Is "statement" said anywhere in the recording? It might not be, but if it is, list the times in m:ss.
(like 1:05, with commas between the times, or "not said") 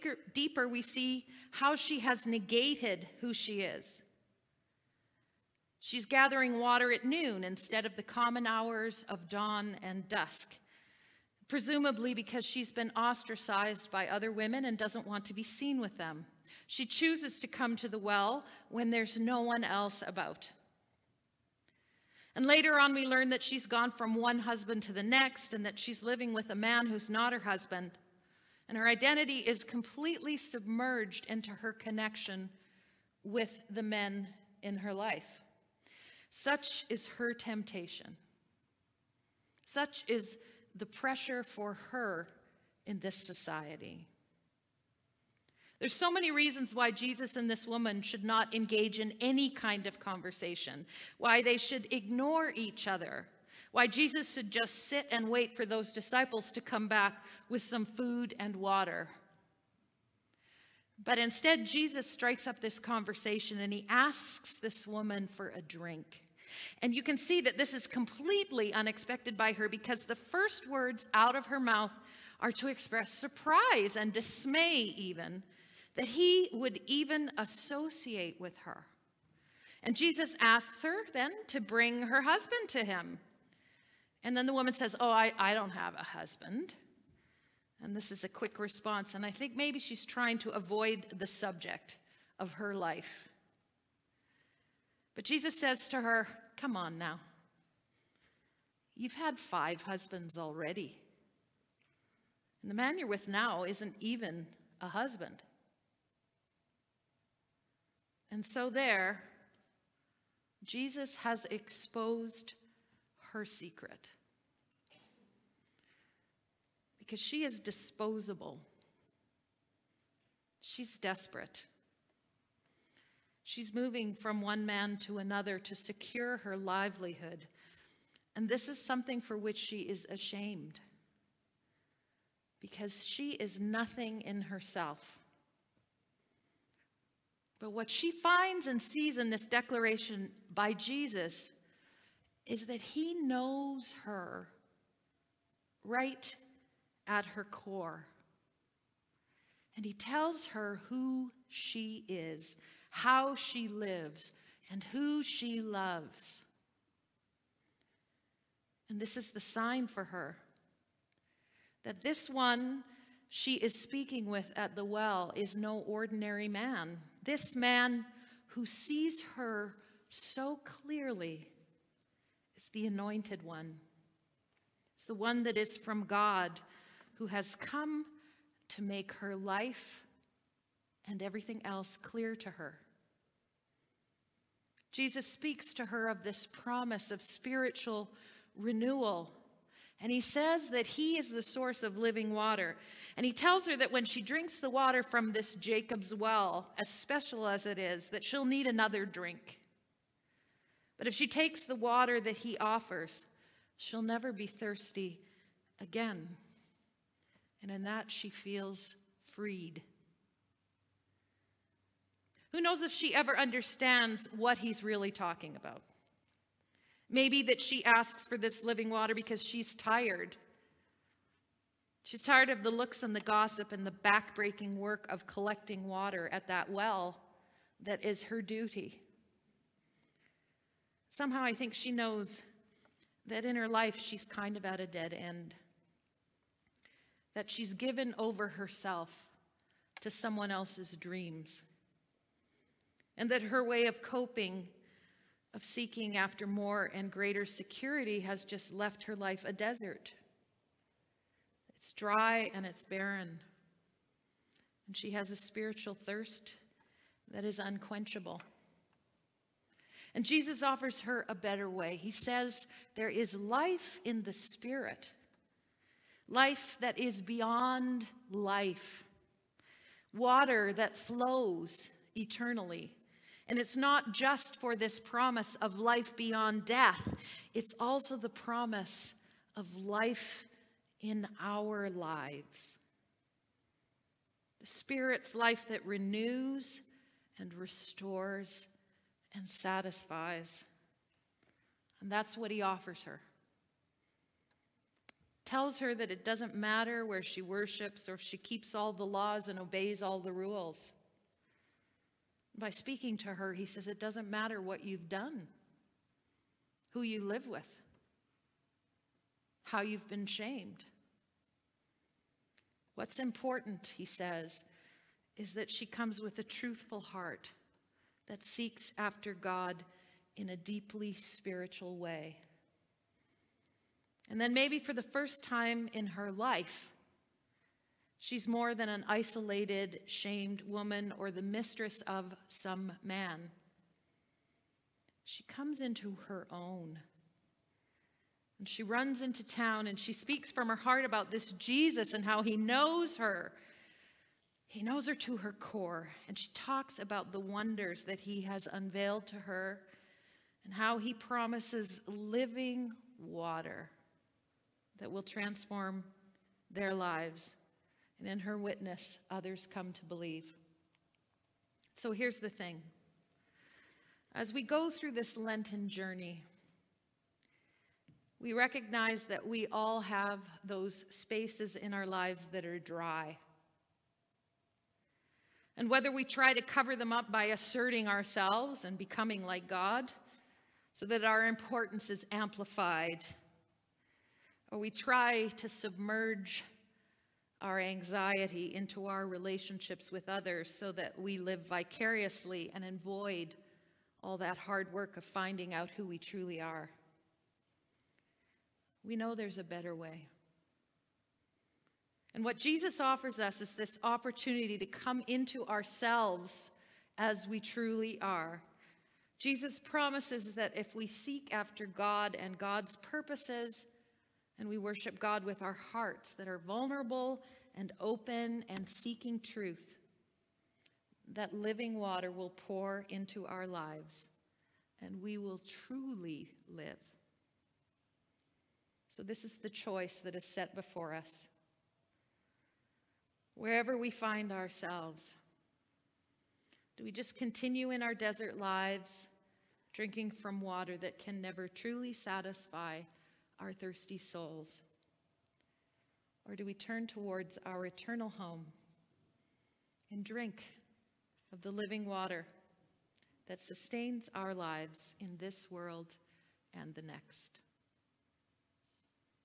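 not said.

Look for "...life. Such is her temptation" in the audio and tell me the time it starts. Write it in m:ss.
0:34.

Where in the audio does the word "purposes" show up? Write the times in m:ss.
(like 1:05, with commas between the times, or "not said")
6:52.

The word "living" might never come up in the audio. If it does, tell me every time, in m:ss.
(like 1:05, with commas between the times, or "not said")
0:26, 3:11, 3:38, 5:52, 7:01, 7:31.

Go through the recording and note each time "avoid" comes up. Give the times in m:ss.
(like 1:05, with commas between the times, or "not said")
1:30, 6:32.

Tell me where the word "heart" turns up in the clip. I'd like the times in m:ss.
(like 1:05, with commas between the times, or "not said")
5:16, 5:40, 6:55.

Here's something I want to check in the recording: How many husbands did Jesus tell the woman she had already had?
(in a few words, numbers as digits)
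5.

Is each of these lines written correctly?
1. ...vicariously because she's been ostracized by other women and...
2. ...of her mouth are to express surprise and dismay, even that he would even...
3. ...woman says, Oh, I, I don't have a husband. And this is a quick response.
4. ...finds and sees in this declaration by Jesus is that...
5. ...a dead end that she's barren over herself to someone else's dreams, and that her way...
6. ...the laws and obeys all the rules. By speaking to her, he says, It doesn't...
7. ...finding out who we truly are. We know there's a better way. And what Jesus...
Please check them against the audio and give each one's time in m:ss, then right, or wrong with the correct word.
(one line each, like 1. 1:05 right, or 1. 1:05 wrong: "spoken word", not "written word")
1. 0:11 wrong: "presumably", not "vicariously"
2. 1:11 right
3. 1:24 right
4. 2:18 right
5. 3:54 wrong: "given", not "barren"
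6. 4:58 right
7. 6:35 right.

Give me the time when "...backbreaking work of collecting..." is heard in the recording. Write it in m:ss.
3:43.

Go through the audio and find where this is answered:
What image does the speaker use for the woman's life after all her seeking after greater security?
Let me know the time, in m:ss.
4:09.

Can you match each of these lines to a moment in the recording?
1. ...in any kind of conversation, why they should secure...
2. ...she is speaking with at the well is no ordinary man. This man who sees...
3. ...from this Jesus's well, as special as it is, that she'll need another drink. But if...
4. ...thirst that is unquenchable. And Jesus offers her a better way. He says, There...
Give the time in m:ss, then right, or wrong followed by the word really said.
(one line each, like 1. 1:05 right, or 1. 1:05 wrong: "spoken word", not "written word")
1. 0:48 wrong: "ignore", not "secure"
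2. 2:43 right
3. 3:15 wrong: "Jacob", not "Jesus"
4. 4:15 right.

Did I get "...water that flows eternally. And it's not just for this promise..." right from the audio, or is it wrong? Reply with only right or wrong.
right.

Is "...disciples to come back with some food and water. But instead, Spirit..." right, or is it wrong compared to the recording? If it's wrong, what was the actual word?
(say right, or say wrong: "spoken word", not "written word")
wrong: "Jesus", not "Spirit".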